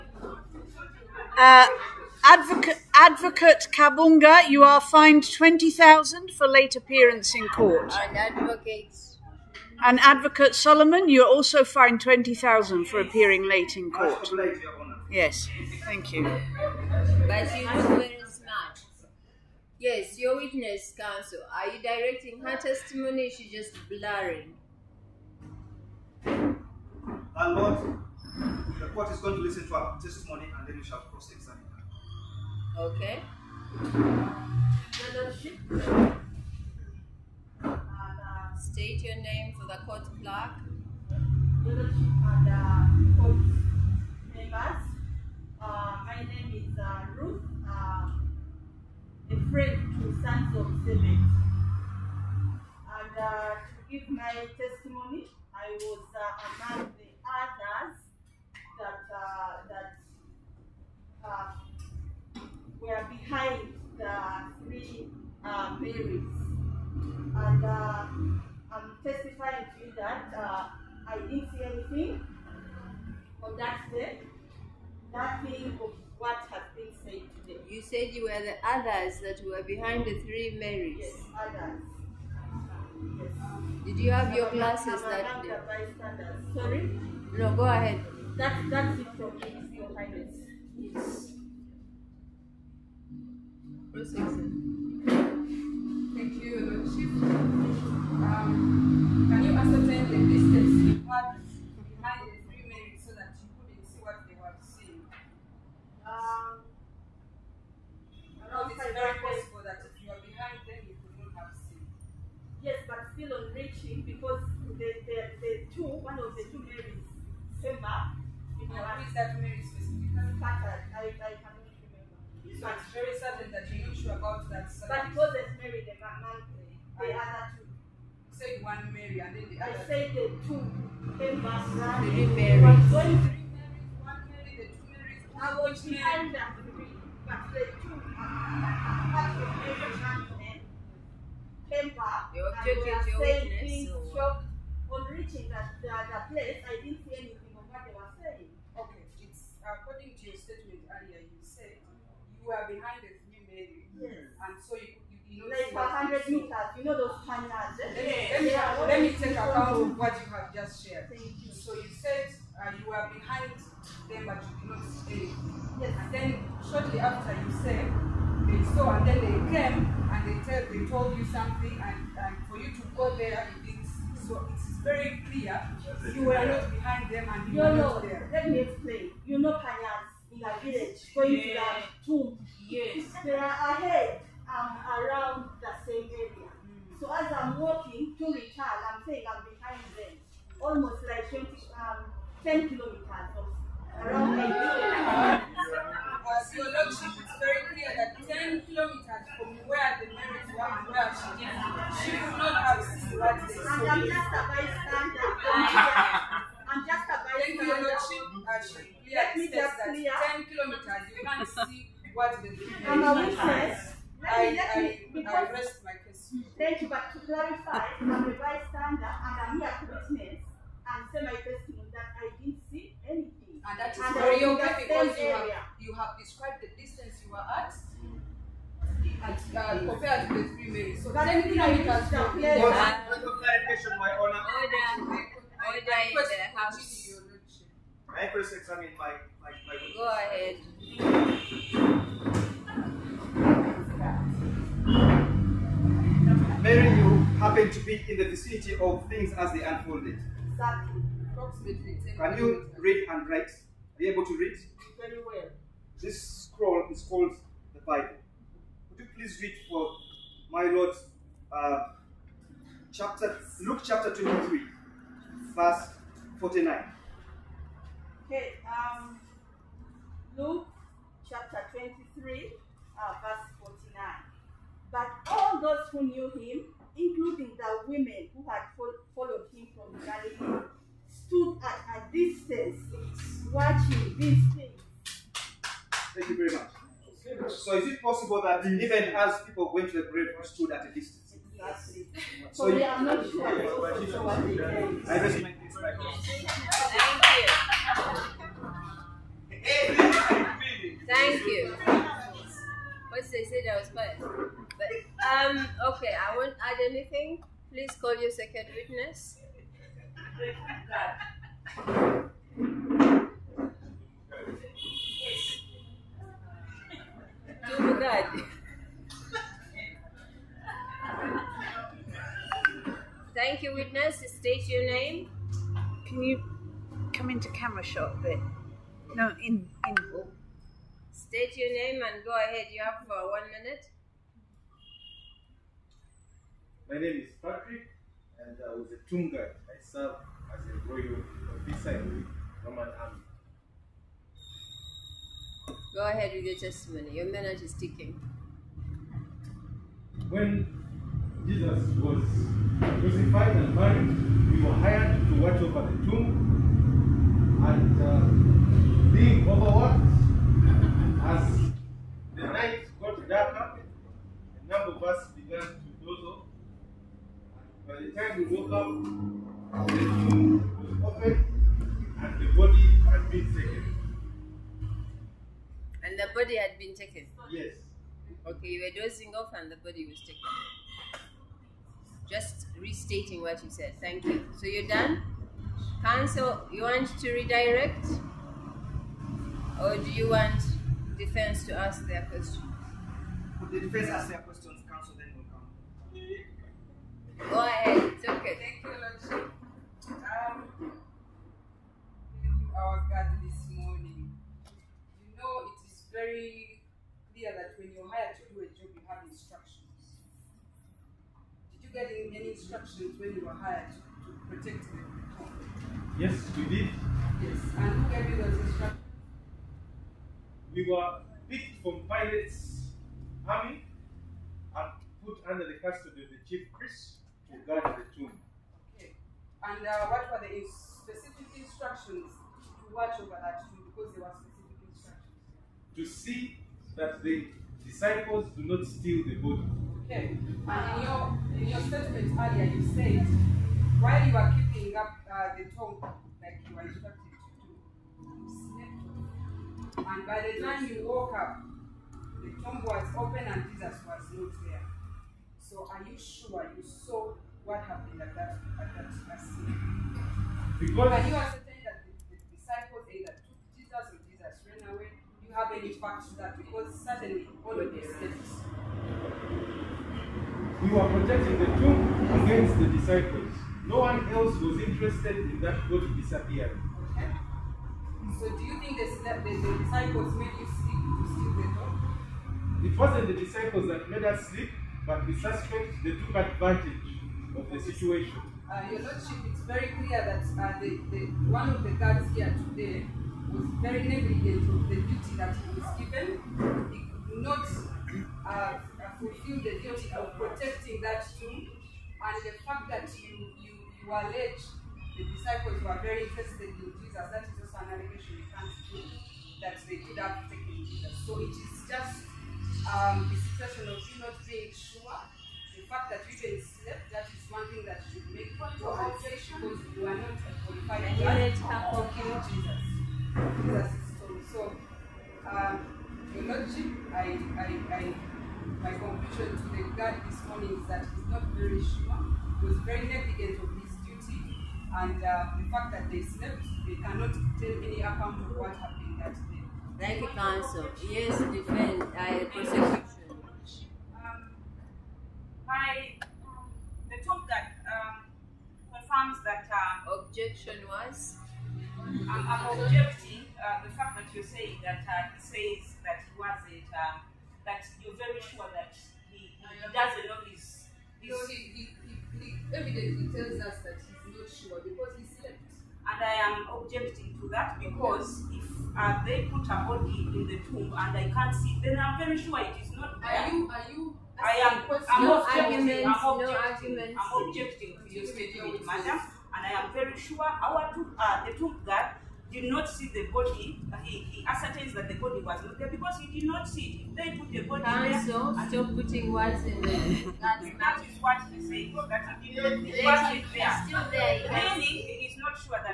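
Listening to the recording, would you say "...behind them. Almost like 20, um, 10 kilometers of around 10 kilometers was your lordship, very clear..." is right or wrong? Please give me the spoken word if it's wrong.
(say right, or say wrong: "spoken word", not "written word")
right.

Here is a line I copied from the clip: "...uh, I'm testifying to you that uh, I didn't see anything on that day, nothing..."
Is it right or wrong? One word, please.
right.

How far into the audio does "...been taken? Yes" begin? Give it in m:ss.
6:16.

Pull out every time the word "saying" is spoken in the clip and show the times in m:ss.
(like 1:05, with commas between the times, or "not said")
3:09, 9:14.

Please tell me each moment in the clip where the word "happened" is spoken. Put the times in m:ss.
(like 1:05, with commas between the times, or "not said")
7:37, 8:58.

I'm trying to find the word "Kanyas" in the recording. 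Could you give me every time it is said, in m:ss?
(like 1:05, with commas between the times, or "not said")
2:59.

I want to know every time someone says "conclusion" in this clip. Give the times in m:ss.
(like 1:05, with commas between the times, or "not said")
8:48.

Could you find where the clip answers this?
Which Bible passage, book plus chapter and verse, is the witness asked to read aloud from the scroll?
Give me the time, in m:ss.
4:23.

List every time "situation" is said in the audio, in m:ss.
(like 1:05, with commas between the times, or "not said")
8:07, 8:33.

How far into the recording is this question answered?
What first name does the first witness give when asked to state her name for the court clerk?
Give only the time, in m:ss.
0:47.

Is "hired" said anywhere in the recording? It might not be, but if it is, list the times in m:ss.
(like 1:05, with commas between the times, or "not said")
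5:54, 6:48, 6:53.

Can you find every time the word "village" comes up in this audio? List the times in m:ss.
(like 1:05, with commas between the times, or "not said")
3:00.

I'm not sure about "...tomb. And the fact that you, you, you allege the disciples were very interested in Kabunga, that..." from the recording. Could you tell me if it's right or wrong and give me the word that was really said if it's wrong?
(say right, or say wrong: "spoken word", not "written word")
wrong: "Jesus", not "Kabunga".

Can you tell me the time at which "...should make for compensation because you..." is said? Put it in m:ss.
8:38.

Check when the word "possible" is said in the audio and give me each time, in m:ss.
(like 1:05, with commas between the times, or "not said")
1:49, 4:48.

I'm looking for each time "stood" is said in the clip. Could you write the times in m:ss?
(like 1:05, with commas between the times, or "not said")
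4:41, 4:50.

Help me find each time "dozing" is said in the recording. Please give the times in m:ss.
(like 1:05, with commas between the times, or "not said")
6:19.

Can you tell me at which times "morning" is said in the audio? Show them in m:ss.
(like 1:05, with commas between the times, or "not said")
6:43, 8:50.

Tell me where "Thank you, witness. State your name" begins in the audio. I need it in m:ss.
5:23.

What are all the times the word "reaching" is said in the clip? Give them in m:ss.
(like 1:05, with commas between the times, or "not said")
1:53, 2:25.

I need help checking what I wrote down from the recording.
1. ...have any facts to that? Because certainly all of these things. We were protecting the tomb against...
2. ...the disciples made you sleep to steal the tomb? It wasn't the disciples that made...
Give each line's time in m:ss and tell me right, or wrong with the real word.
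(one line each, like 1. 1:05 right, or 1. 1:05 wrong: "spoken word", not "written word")
1. 7:45 right
2. 7:59 right.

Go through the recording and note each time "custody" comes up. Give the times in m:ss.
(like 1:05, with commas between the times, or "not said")
7:05.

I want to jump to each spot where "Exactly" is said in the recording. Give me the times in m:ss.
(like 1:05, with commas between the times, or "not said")
4:10, 4:51.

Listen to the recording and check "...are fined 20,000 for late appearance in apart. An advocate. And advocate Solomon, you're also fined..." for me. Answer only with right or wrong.
wrong.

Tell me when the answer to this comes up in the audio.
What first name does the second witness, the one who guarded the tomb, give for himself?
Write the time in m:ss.
5:37.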